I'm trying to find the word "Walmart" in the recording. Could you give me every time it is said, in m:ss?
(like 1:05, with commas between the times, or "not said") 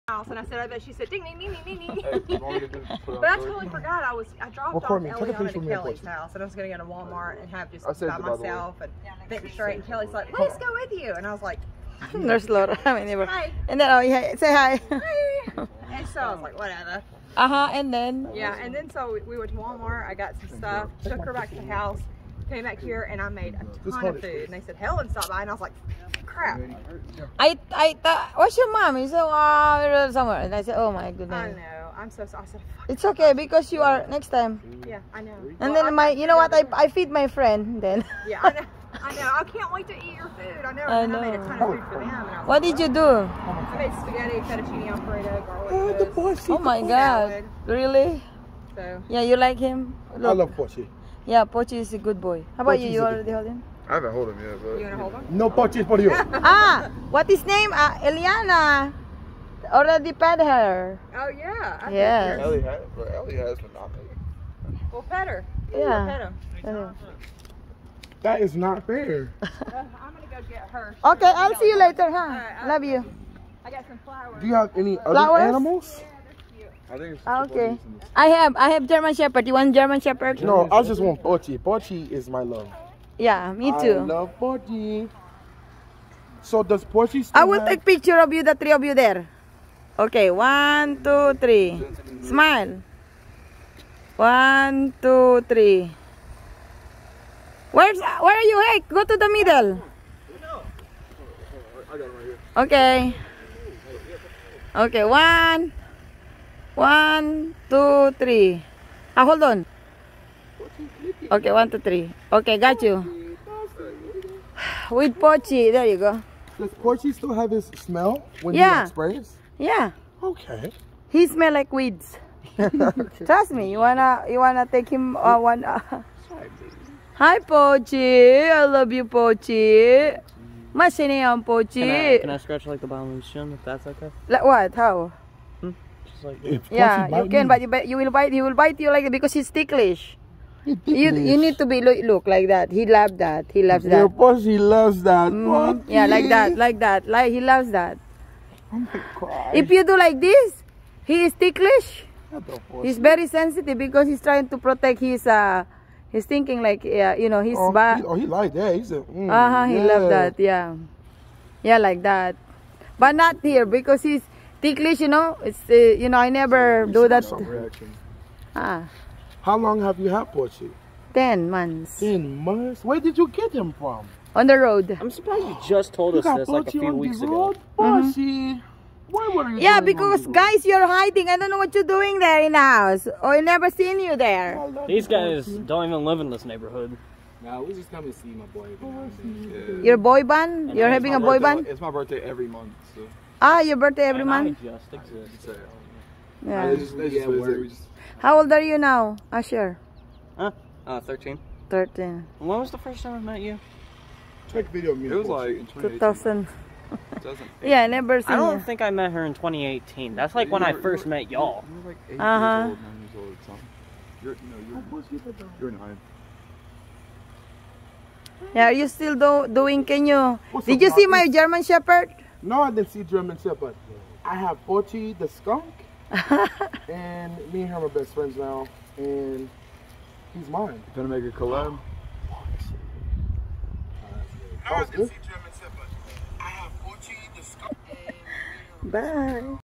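0:06, 0:19.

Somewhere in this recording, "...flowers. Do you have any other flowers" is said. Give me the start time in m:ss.
1:14.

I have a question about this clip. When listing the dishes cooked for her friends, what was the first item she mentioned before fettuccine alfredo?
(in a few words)
Spaghetti.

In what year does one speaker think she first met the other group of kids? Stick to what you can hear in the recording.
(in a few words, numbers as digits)
2018.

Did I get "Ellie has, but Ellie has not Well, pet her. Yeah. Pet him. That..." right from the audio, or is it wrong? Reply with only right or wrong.
right.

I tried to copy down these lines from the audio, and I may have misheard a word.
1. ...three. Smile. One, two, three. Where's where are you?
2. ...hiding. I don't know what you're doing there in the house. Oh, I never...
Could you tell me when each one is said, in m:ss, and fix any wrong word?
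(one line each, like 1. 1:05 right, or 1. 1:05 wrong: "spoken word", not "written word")
1. 1:31 right
2. 3:00 right.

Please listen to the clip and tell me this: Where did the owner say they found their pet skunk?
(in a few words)
On the road.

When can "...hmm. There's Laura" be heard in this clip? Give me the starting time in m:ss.
0:12.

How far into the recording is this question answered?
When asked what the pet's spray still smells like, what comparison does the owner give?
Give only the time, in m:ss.
2:01.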